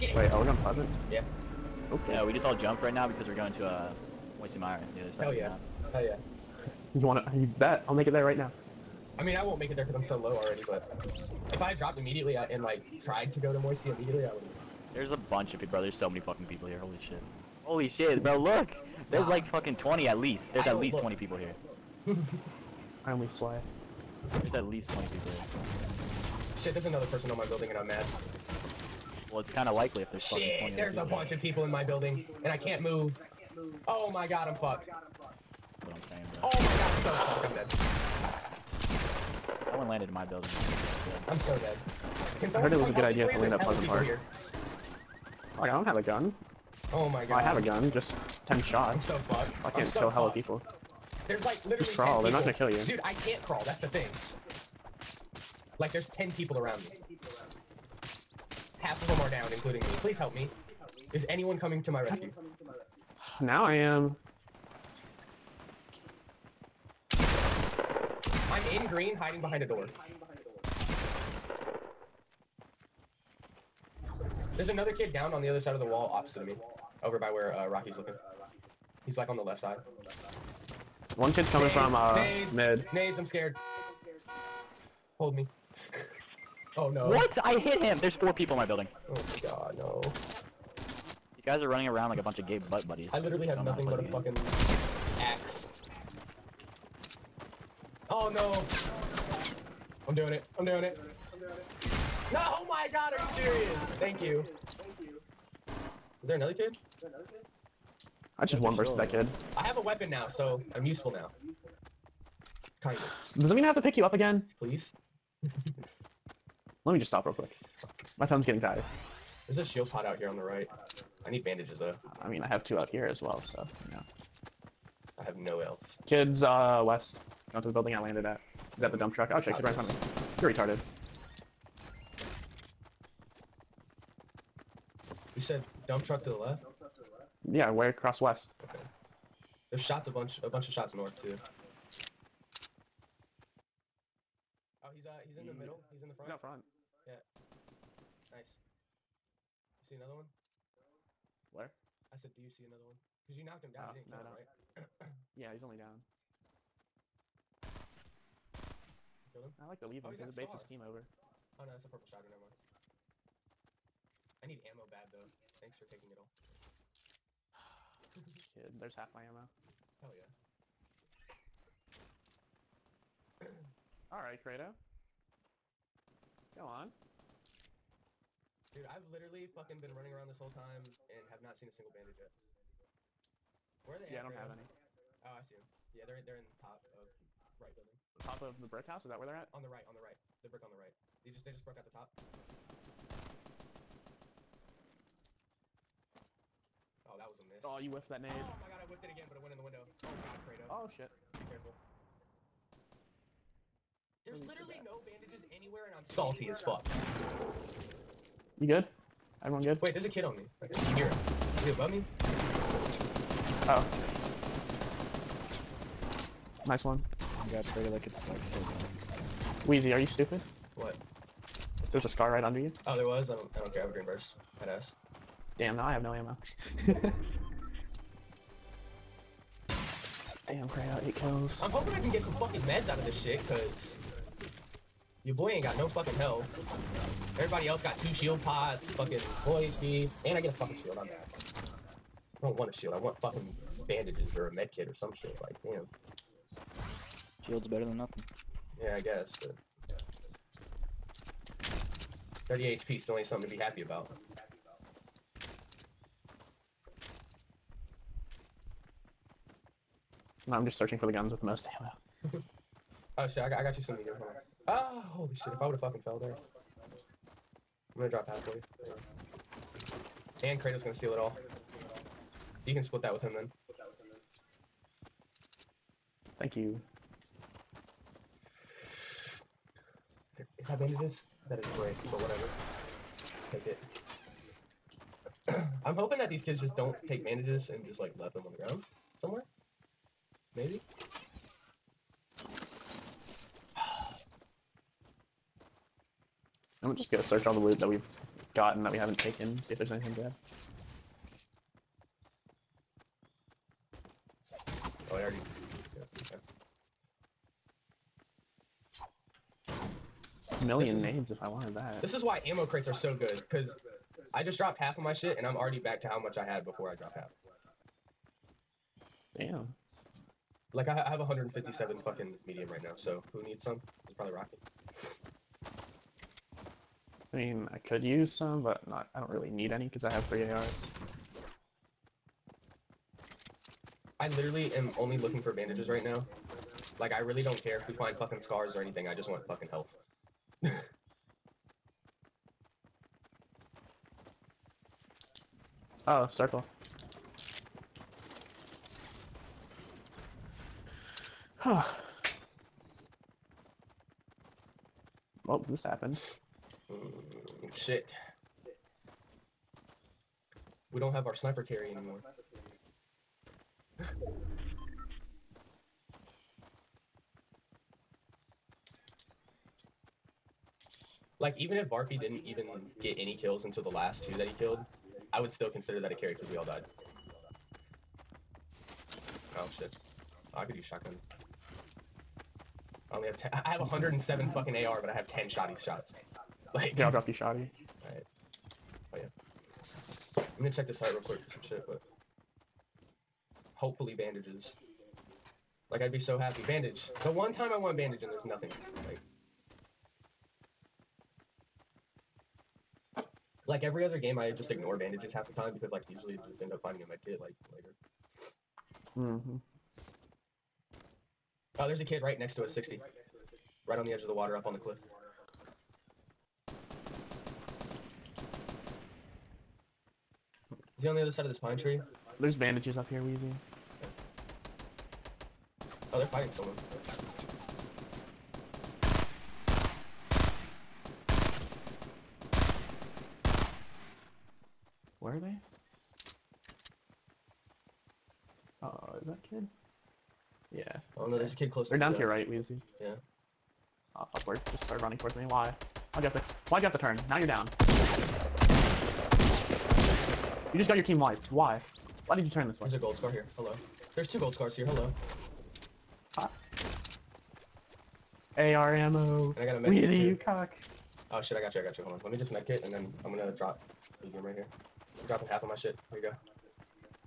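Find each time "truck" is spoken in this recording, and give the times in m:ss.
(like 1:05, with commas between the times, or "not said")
2:09, 2:16.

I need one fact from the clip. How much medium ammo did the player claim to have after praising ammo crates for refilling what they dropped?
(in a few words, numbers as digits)
157.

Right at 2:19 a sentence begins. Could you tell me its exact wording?
There's shots a bunch a bunch of shots north too.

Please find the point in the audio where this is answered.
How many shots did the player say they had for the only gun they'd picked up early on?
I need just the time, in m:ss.
0:48.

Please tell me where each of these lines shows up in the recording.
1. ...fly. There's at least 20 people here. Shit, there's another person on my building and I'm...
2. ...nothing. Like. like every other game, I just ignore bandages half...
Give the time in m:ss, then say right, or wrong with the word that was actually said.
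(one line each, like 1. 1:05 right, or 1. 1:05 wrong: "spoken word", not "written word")
1. 0:23 right
2. 6:38 right.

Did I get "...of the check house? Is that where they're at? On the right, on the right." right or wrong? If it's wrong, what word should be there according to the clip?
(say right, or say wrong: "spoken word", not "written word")
wrong: "brick", not "check".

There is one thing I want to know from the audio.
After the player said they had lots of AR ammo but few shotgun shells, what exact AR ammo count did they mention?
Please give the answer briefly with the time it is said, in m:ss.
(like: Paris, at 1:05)
107, at 6:23.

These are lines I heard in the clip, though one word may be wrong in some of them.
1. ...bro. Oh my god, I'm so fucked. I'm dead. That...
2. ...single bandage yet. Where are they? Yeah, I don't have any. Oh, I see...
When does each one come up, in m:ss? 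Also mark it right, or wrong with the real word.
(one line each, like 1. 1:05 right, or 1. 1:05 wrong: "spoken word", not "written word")
1. 0:36 right
2. 3:01 right.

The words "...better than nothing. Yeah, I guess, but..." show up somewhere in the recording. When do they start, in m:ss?
4:07.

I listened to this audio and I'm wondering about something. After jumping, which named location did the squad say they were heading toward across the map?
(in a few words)
Moisty Mire.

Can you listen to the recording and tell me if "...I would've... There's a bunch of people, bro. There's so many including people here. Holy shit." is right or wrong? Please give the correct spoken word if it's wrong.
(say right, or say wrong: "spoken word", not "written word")
wrong: "fucking", not "including".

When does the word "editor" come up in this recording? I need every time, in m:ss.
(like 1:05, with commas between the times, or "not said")
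not said.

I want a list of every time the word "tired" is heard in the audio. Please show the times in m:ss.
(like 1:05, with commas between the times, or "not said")
1:58.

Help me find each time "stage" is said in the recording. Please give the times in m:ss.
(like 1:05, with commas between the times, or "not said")
not said.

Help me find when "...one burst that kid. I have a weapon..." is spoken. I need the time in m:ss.
1:48.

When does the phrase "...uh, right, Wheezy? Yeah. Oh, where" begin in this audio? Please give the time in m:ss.
7:22.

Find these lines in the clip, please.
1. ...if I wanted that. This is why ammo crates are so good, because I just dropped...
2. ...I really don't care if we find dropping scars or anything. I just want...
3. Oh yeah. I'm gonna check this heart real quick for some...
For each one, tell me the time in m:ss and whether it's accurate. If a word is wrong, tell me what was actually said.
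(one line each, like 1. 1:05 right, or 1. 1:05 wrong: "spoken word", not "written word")
1. 5:11 right
2. 5:37 wrong: "fucking", not "dropping"
3. 6:29 right.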